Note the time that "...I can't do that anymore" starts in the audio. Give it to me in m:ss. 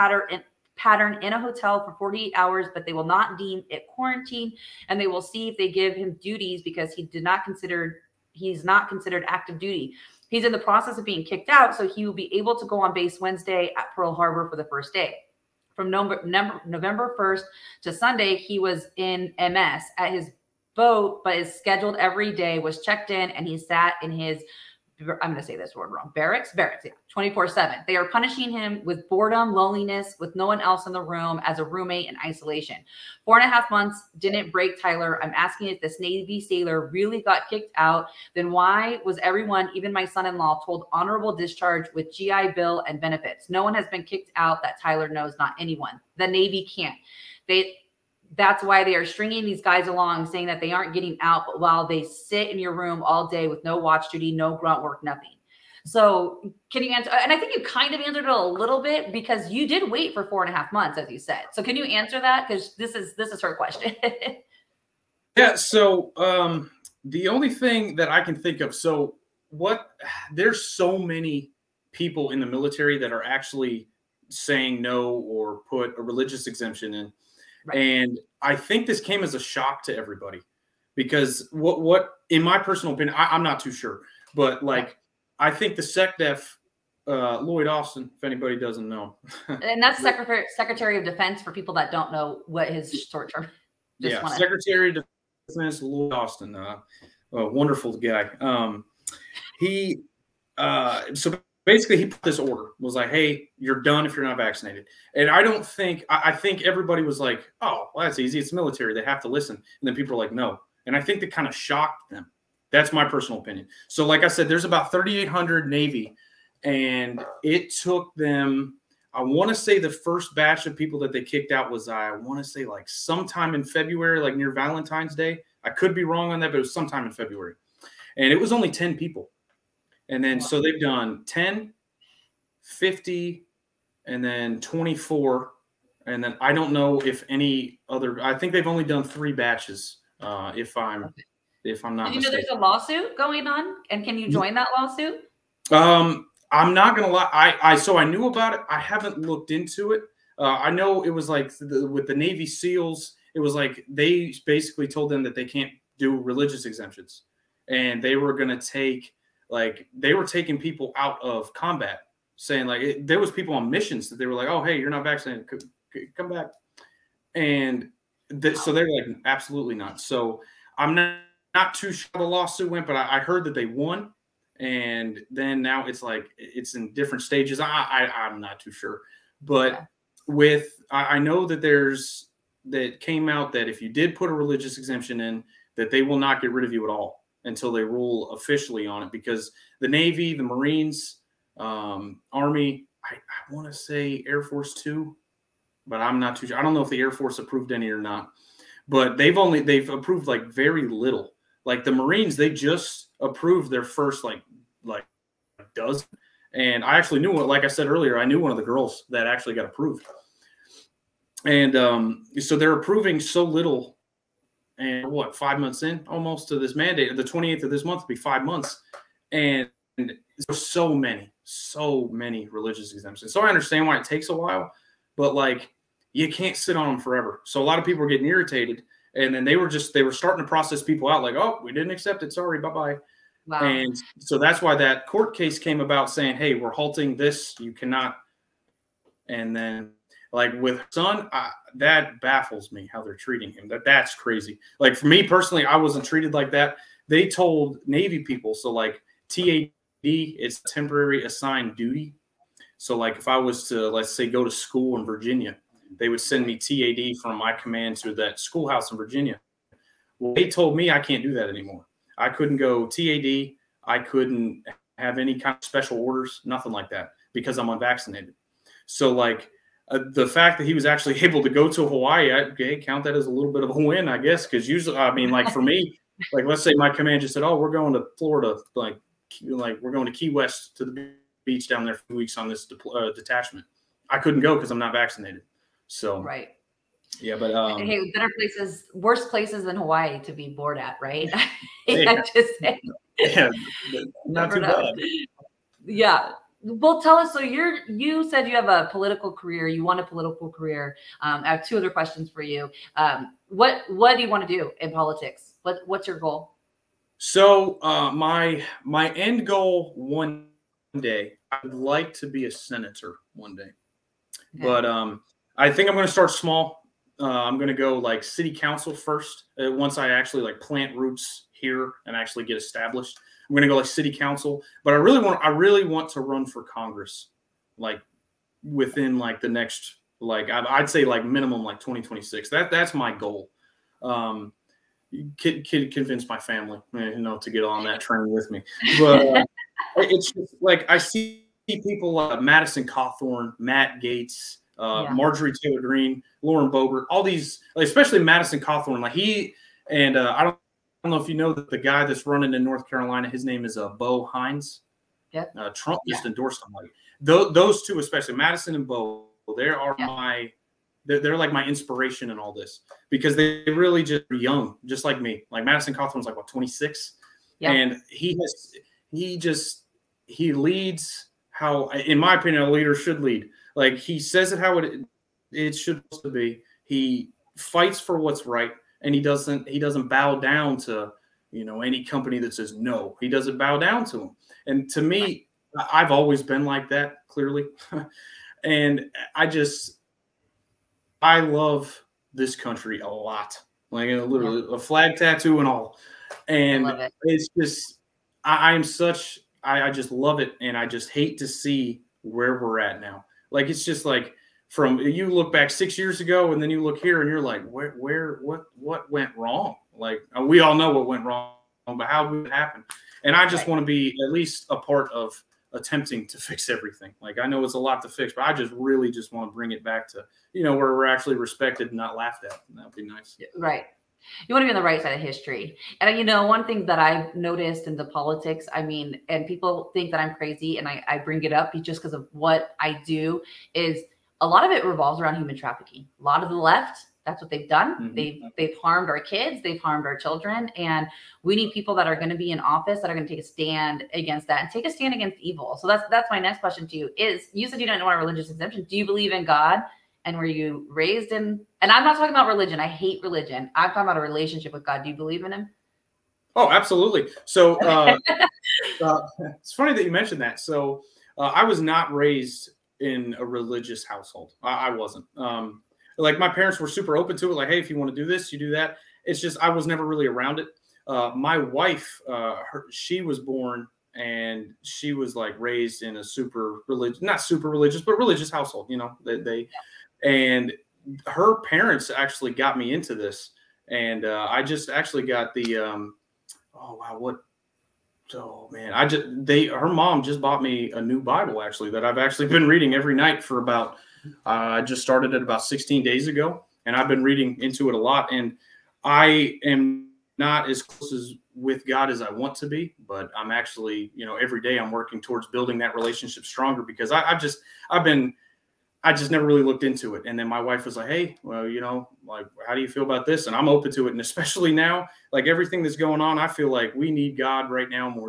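4:20.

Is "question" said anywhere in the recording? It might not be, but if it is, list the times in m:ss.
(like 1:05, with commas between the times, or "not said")
1:03, 5:01, 7:26.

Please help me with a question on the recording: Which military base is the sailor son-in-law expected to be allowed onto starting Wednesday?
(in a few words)
Pearl Harbor.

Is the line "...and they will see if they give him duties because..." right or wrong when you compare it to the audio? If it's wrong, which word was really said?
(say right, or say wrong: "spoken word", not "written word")
right.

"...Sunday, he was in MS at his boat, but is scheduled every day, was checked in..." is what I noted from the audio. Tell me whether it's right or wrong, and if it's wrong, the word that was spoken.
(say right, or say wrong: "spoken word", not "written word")
right.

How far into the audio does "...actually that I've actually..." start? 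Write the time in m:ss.
8:11.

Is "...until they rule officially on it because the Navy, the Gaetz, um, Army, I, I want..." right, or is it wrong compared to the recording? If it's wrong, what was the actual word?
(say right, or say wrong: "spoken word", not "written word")
wrong: "Marines", not "Gaetz".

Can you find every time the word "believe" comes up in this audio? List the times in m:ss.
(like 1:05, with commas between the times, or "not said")
7:29, 7:35.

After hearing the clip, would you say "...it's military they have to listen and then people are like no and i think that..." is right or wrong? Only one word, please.
right.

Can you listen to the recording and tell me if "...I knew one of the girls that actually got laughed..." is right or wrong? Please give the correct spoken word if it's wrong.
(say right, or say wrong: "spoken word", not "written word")
wrong: "approved", not "laughed".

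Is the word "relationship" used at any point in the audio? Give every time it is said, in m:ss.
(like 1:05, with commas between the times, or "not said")
7:34, 8:25.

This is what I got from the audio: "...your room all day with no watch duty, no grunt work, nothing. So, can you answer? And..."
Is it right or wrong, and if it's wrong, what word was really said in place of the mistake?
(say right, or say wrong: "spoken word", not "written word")
right.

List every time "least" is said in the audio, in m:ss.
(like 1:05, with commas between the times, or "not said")
6:54.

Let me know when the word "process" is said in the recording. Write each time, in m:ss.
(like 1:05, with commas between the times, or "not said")
0:10, 3:50.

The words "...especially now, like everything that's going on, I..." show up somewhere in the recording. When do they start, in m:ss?
8:34.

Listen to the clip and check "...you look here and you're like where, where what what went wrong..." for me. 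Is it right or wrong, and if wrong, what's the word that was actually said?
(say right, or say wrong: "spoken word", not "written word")
right.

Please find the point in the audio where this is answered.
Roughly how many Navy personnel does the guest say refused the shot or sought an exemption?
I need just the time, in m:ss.
1:54.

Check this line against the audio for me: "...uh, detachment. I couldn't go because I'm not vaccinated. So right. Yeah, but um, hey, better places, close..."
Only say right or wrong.
wrong.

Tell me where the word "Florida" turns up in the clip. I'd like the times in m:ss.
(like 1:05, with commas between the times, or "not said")
4:38.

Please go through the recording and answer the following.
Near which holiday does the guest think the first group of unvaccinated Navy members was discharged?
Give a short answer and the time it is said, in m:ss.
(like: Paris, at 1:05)
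Valentine's Day, at 2:04.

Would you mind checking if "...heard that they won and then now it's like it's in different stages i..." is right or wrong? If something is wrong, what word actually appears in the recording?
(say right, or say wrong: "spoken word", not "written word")
right.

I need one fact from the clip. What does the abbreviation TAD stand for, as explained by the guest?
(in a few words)
temporary assigned duty.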